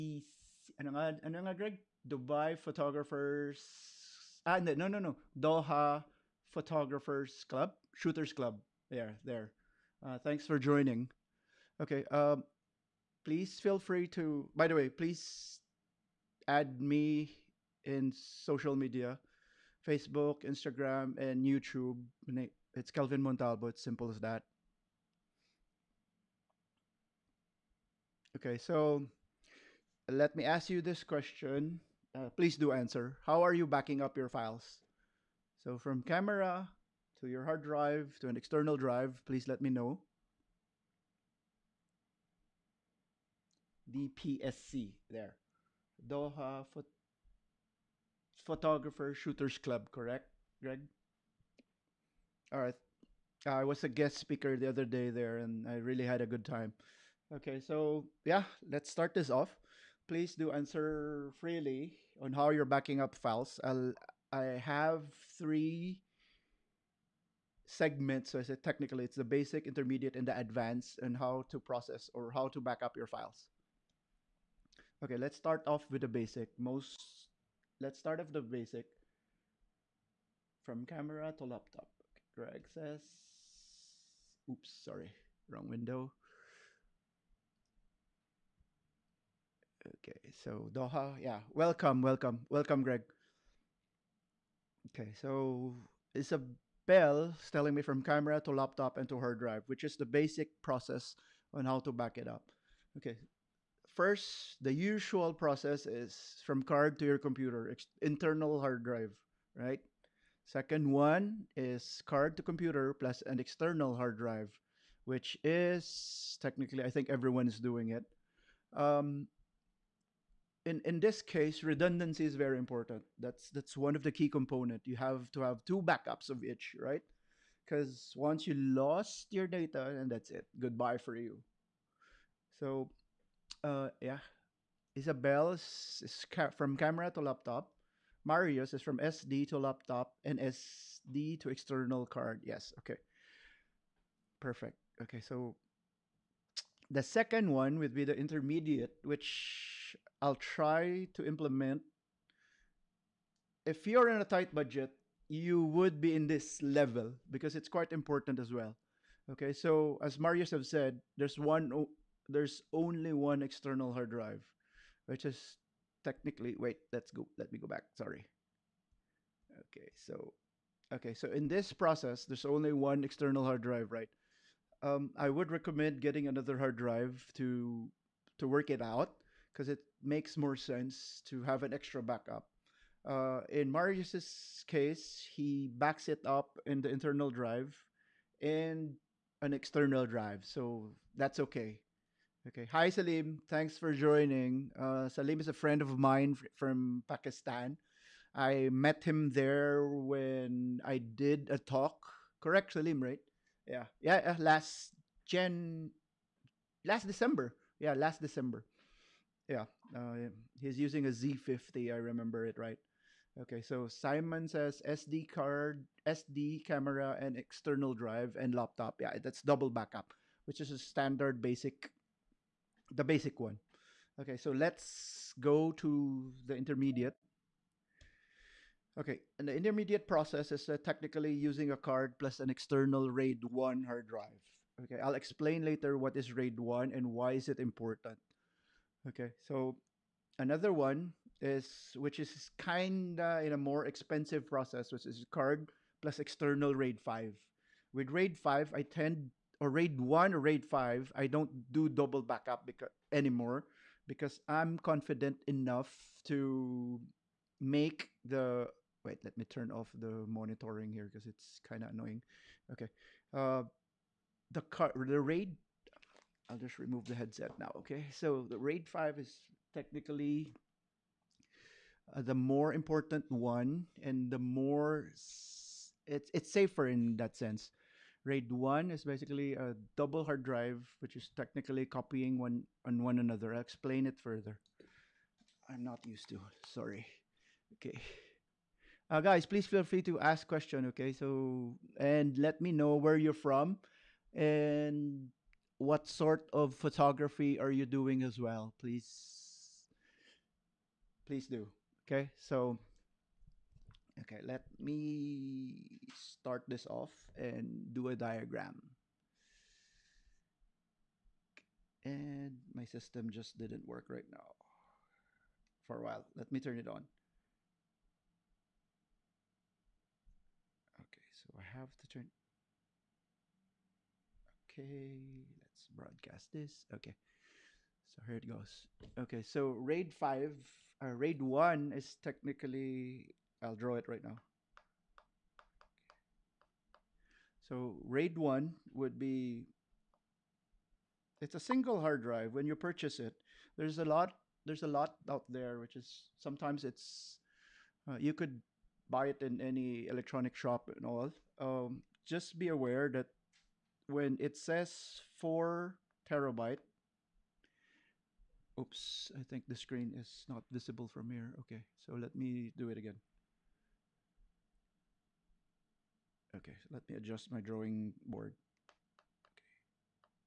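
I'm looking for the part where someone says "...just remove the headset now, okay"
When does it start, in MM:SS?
04:26.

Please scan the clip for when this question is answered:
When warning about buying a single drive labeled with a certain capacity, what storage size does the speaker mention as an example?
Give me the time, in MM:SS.
05:55.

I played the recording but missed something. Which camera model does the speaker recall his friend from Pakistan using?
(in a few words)
Z50.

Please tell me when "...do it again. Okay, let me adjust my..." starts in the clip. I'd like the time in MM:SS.
06:02.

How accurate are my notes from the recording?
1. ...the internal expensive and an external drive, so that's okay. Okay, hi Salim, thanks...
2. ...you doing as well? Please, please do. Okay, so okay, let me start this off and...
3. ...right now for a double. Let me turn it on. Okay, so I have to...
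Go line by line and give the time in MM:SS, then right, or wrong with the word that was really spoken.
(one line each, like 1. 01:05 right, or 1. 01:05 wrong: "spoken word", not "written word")
1. 03:06 wrong: "drive", not "expensive"
2. 04:57 right
3. 05:14 wrong: "while", not "double".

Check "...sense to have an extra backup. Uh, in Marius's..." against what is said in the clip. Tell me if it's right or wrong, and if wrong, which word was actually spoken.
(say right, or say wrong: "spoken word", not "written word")
right.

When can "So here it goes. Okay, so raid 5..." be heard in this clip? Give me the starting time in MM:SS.
05:28.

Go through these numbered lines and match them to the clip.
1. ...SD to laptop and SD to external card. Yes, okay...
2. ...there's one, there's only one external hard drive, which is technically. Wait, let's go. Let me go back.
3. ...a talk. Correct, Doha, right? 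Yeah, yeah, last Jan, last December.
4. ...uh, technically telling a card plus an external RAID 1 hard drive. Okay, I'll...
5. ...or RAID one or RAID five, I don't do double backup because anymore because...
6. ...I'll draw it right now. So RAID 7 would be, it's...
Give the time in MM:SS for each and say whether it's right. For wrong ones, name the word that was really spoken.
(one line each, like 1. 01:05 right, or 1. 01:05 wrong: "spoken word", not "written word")
1. 02:18 right
2. 02:41 right
3. 03:21 wrong: "Salim", not "Doha"
4. 03:50 wrong: "using", not "telling"
5. 04:09 right
6. 05:33 wrong: "1", not "7".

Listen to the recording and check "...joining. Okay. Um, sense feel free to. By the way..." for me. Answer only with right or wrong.
wrong.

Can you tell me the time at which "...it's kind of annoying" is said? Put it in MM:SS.
04:21.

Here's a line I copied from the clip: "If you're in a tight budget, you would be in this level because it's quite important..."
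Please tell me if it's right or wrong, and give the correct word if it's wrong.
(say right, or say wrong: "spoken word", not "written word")
right.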